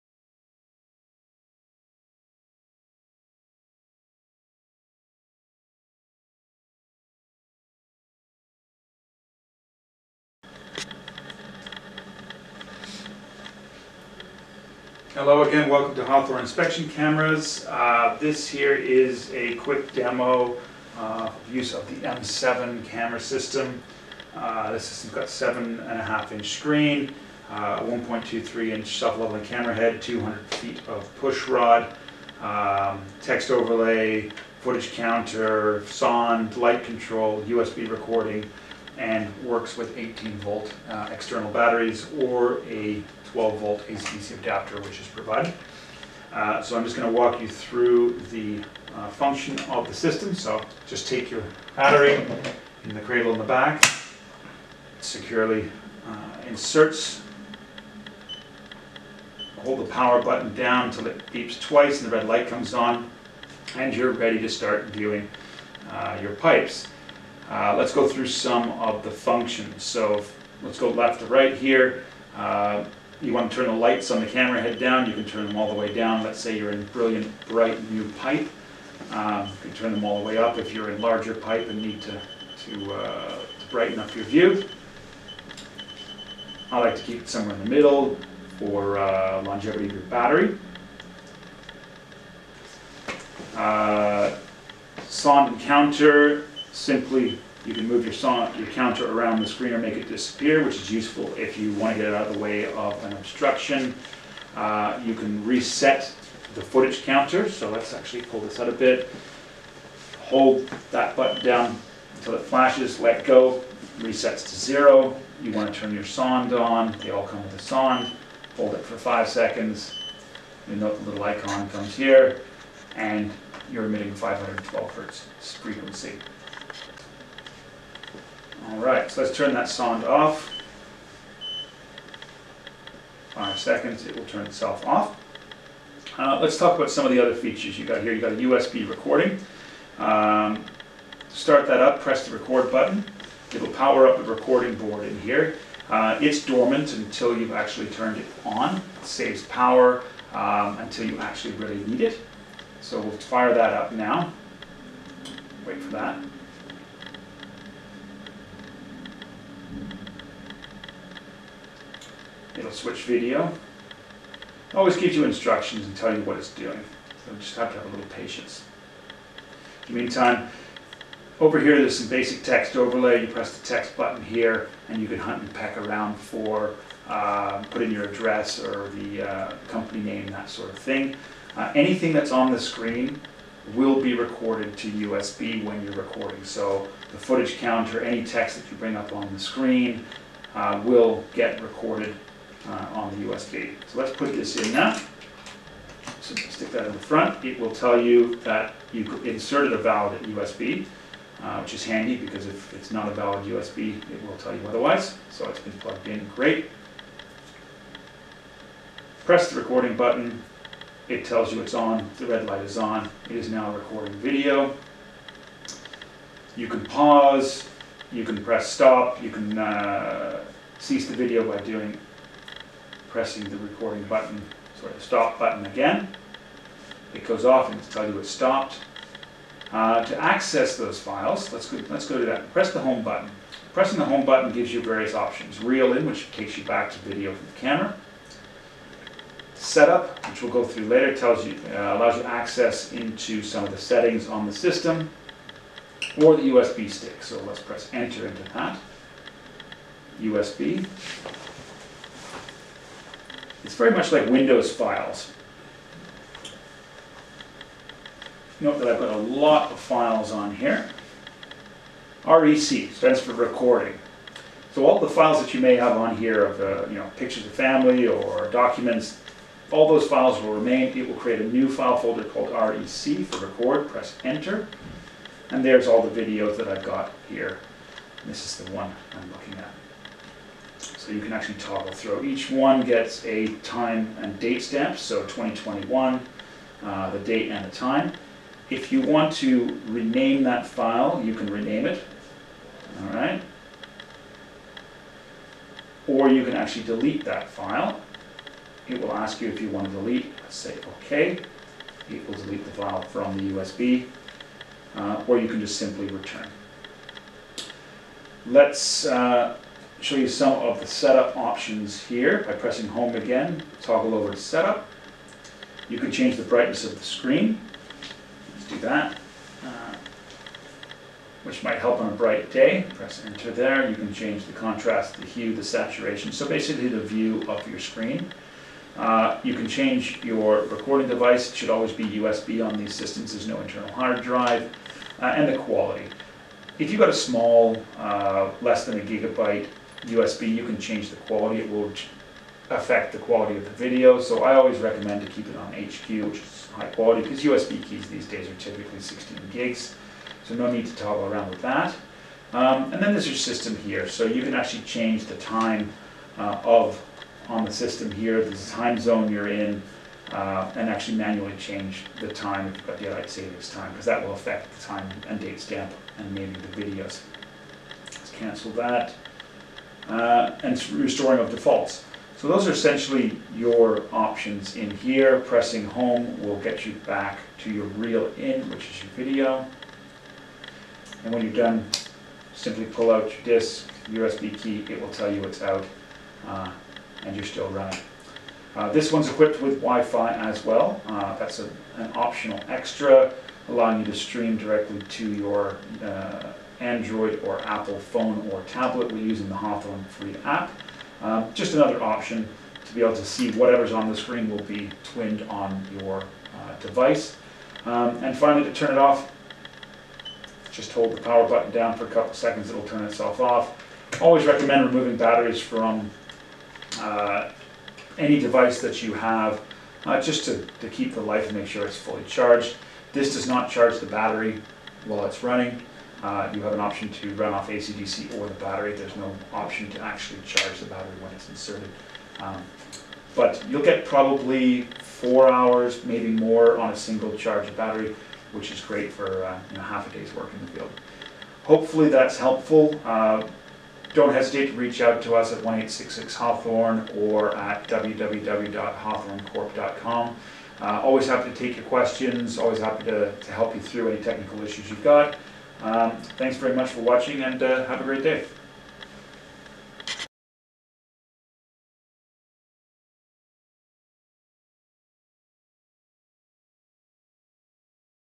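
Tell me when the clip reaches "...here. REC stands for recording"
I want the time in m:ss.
4:20.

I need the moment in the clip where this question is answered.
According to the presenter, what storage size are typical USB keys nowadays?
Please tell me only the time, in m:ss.
5:48.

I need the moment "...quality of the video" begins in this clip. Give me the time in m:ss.
5:43.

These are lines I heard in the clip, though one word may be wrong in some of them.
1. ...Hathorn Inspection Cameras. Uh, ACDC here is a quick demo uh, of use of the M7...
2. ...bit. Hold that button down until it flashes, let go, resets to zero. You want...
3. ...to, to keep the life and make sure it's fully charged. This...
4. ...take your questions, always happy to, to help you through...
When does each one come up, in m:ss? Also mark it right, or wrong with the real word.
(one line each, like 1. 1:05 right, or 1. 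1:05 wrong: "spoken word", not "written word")
1. 0:16 wrong: "This", not "ACDC"
2. 1:48 right
3. 7:00 right
4. 7:31 right.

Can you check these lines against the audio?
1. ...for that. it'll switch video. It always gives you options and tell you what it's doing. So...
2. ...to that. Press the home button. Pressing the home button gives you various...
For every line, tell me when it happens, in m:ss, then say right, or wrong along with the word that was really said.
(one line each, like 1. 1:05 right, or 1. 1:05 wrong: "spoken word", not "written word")
1. 2:35 wrong: "instructions", not "options"
2. 3:52 right.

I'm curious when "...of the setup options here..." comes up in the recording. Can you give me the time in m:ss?
5:10.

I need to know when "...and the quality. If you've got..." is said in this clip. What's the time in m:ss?
5:35.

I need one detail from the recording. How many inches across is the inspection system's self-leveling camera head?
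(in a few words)
1.23 inch.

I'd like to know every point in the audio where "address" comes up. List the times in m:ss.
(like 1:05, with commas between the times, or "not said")
2:58.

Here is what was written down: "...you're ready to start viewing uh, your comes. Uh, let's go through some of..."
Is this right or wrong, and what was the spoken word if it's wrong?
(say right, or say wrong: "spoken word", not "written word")
wrong: "pipes", not "comes".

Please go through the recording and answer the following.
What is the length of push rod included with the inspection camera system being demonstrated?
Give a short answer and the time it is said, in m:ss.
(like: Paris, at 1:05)
200 feet, at 0:30.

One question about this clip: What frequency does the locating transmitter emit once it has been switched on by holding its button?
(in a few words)
512 hertz.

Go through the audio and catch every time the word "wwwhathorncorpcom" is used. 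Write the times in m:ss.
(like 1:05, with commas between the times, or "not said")
7:27.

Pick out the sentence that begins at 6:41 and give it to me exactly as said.
Uh, just another option to be able to see whatever's on the screen will be twinned on your uh, device.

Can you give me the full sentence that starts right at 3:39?
You can uh, cease the video by doing pressing the recording button, sorry, the stop button again.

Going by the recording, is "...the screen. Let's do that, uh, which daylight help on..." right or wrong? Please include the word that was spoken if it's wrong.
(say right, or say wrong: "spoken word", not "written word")
wrong: "might", not "daylight".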